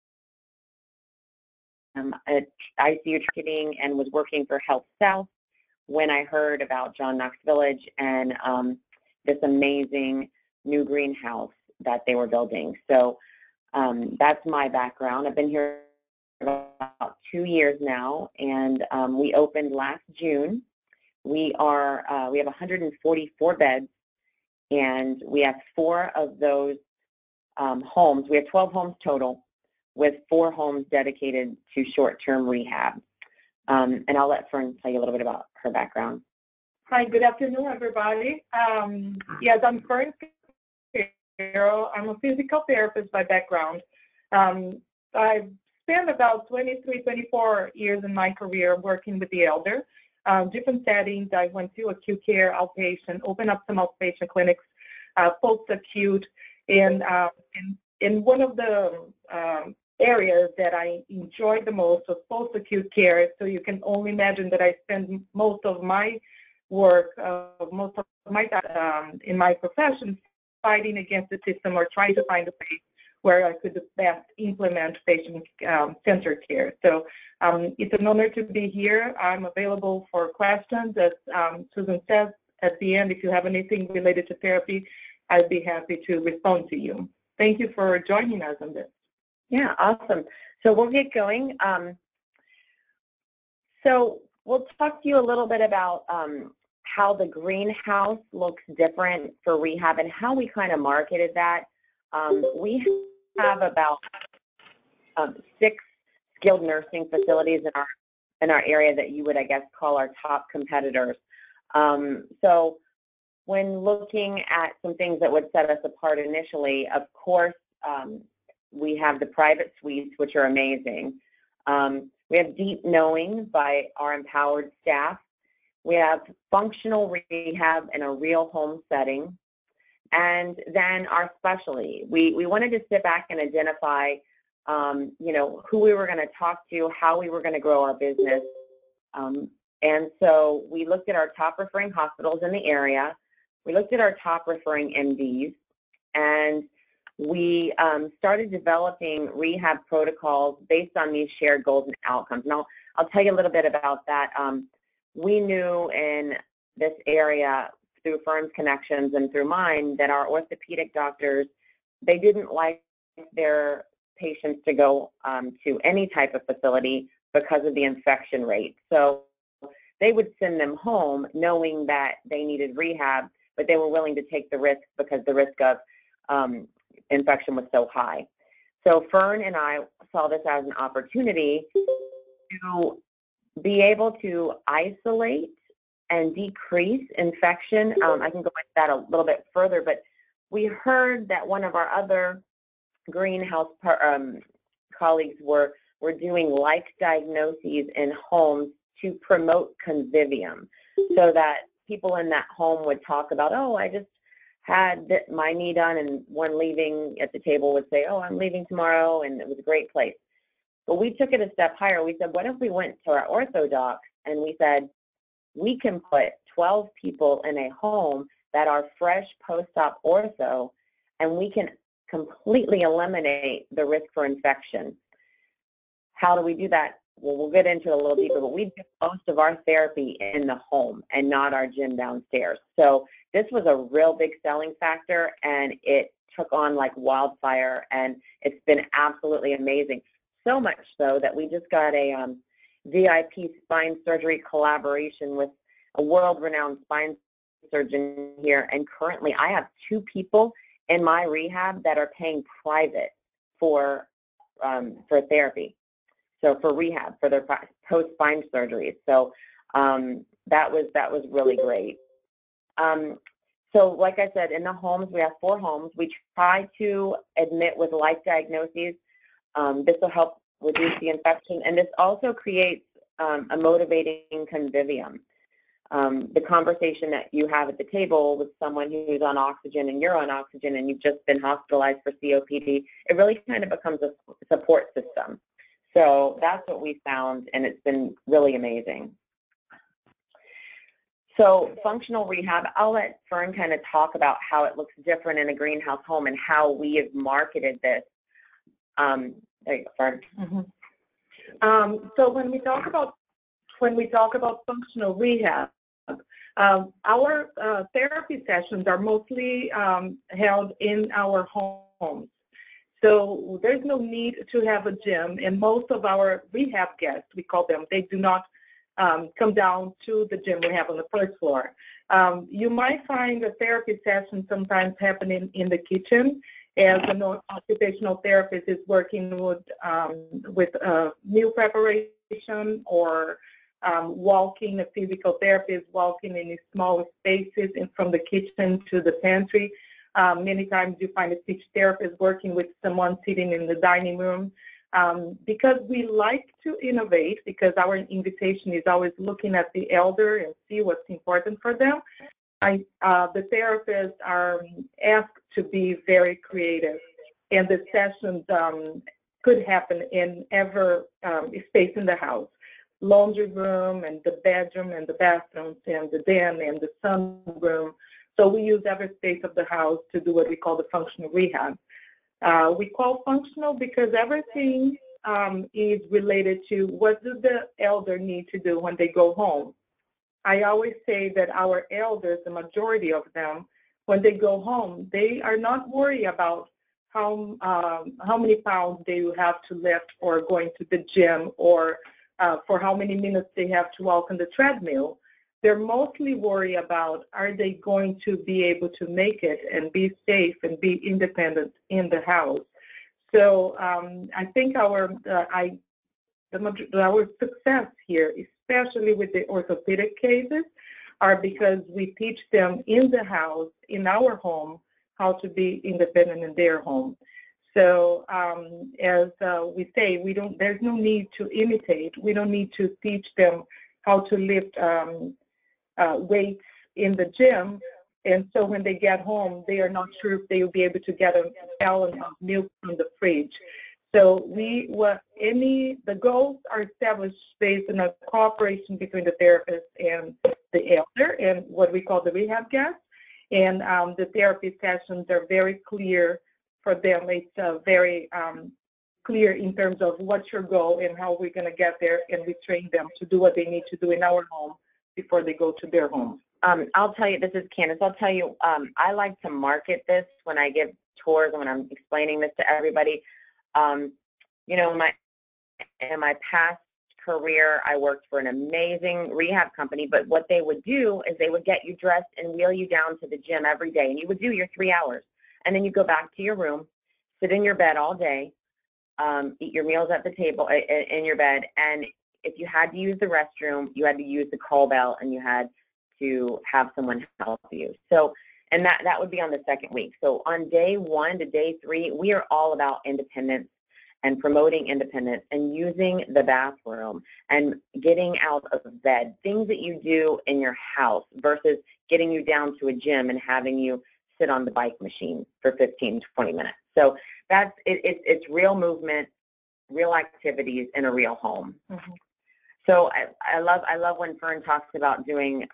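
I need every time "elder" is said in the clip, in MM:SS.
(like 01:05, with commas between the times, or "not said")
00:49, 05:49, 06:17, 06:21, 07:20.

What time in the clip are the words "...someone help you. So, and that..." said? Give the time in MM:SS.
08:06.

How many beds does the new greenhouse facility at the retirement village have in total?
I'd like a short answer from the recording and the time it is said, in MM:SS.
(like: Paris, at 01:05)
144, at 00:22.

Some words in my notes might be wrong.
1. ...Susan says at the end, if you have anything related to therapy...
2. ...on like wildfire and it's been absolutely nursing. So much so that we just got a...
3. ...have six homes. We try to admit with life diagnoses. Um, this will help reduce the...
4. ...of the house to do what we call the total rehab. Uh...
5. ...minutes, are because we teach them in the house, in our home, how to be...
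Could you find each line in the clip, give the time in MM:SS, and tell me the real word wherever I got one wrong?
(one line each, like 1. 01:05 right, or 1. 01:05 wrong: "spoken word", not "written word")
1. 01:21 right
2. 03:56 wrong: "amazing", not "nursing"
3. 04:25 wrong: "four", not "six"
4. 06:09 wrong: "functional", not "total"
5. 06:50 wrong: "cases", not "minutes".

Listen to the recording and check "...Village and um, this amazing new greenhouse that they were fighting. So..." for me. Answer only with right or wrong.
wrong.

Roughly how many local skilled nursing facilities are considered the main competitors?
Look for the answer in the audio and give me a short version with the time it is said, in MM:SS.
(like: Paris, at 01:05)
6, at 01:45.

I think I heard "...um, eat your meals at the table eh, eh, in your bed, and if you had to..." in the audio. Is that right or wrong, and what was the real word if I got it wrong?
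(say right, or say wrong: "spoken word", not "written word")
right.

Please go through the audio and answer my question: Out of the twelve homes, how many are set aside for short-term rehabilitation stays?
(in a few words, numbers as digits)
4.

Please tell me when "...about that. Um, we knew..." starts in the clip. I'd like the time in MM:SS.
02:33.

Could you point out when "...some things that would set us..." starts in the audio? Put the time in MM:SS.
01:54.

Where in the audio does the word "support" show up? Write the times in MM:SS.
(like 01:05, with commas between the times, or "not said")
04:44.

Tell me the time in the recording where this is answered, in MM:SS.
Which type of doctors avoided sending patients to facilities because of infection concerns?
02:40.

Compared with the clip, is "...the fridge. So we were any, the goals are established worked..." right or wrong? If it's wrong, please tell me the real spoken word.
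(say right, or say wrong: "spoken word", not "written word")
wrong: "based", not "worked".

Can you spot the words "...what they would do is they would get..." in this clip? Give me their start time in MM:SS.
07:50.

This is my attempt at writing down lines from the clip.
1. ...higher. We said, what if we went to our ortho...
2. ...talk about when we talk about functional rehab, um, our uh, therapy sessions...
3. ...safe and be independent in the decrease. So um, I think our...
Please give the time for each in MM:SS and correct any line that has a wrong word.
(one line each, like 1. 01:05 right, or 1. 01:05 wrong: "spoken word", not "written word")
1. 03:31 right
2. 05:02 right
3. 06:40 wrong: "house", not "decrease".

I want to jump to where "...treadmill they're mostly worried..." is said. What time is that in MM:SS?
06:34.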